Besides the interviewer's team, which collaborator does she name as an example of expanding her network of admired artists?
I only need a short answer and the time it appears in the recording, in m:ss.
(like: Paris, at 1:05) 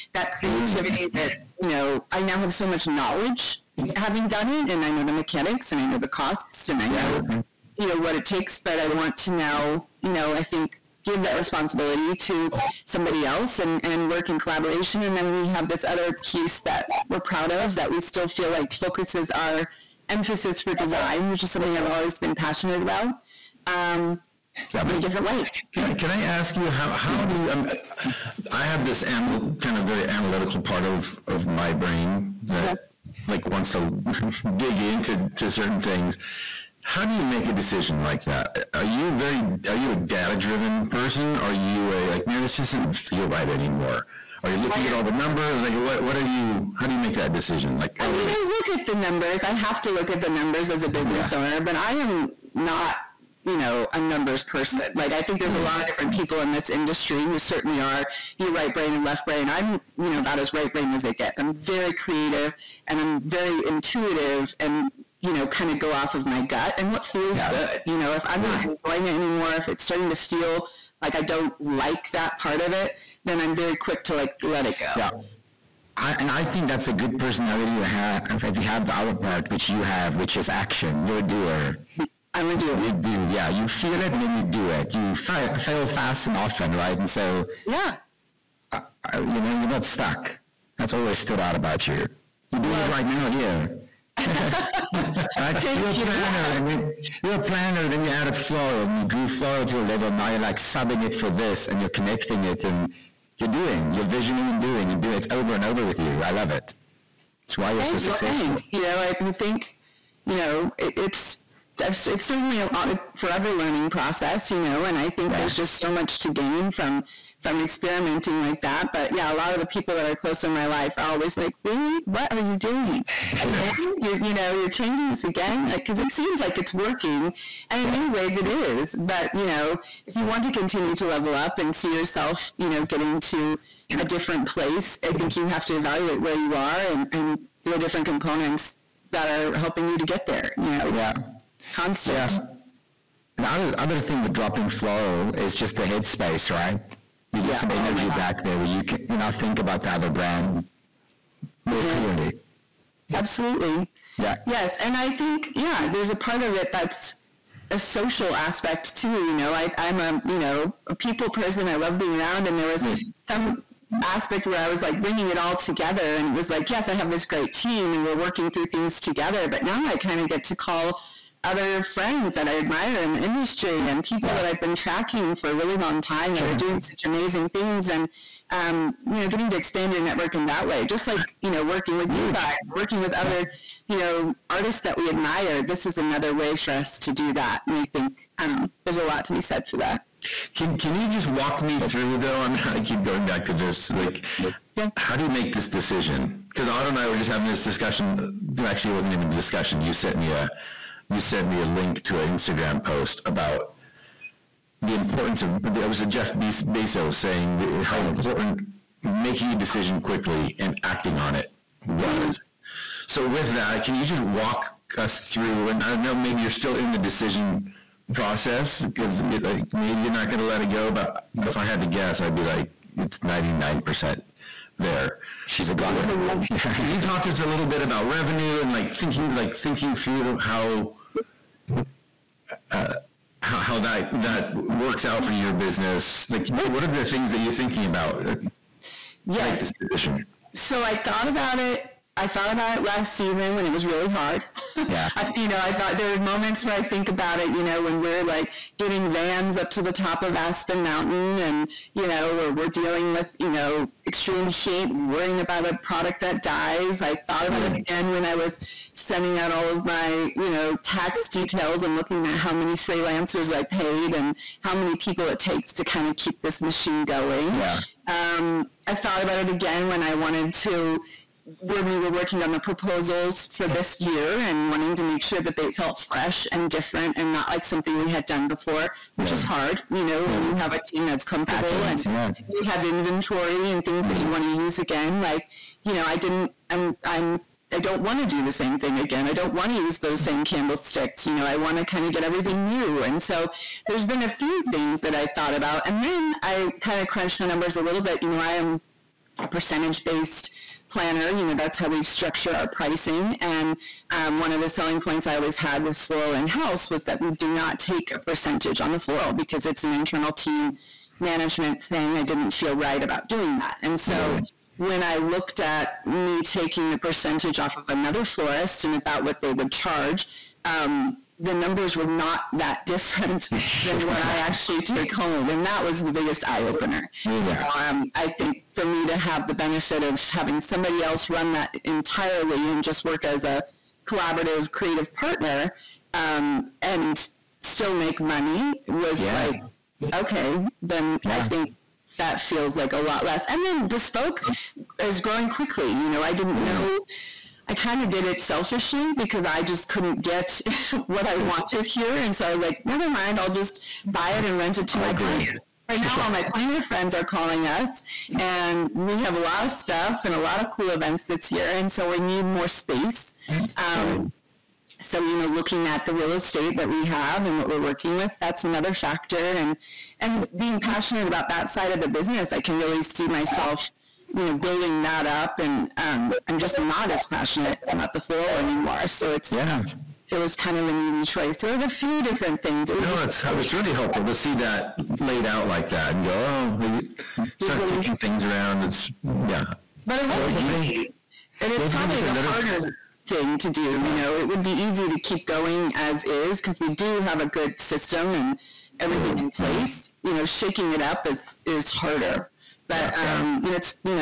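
Huge, at 3:02.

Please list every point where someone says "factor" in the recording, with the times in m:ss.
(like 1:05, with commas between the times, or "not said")
6:08.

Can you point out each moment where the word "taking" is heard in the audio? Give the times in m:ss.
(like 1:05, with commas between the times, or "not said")
5:16, 6:27.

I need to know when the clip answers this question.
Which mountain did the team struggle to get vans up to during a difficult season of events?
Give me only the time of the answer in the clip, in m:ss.
4:10.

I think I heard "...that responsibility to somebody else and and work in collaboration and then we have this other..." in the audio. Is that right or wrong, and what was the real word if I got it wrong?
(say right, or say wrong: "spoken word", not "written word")
right.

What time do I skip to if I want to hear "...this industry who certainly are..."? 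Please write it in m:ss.
0:56.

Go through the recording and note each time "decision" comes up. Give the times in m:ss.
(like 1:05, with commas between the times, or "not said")
0:37, 0:47, 3:15, 3:29, 3:36, 3:59.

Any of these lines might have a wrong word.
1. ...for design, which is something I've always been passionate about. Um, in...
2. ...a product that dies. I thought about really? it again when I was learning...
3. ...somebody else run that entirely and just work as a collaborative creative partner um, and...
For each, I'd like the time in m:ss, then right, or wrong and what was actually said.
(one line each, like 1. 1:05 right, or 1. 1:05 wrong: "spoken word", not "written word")
1. 0:20 right
2. 4:15 wrong: "sending", not "learning"
3. 5:30 right.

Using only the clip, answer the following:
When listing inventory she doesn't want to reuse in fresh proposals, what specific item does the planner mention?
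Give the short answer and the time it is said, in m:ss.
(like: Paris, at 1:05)
candlesticks, at 4:50.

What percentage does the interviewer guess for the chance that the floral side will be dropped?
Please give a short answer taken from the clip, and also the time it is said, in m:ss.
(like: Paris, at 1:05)
99 percent, at 3:43.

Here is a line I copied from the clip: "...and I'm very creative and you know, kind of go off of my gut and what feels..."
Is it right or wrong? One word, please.
wrong.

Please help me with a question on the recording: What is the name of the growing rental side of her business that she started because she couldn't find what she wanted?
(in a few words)
bespoke.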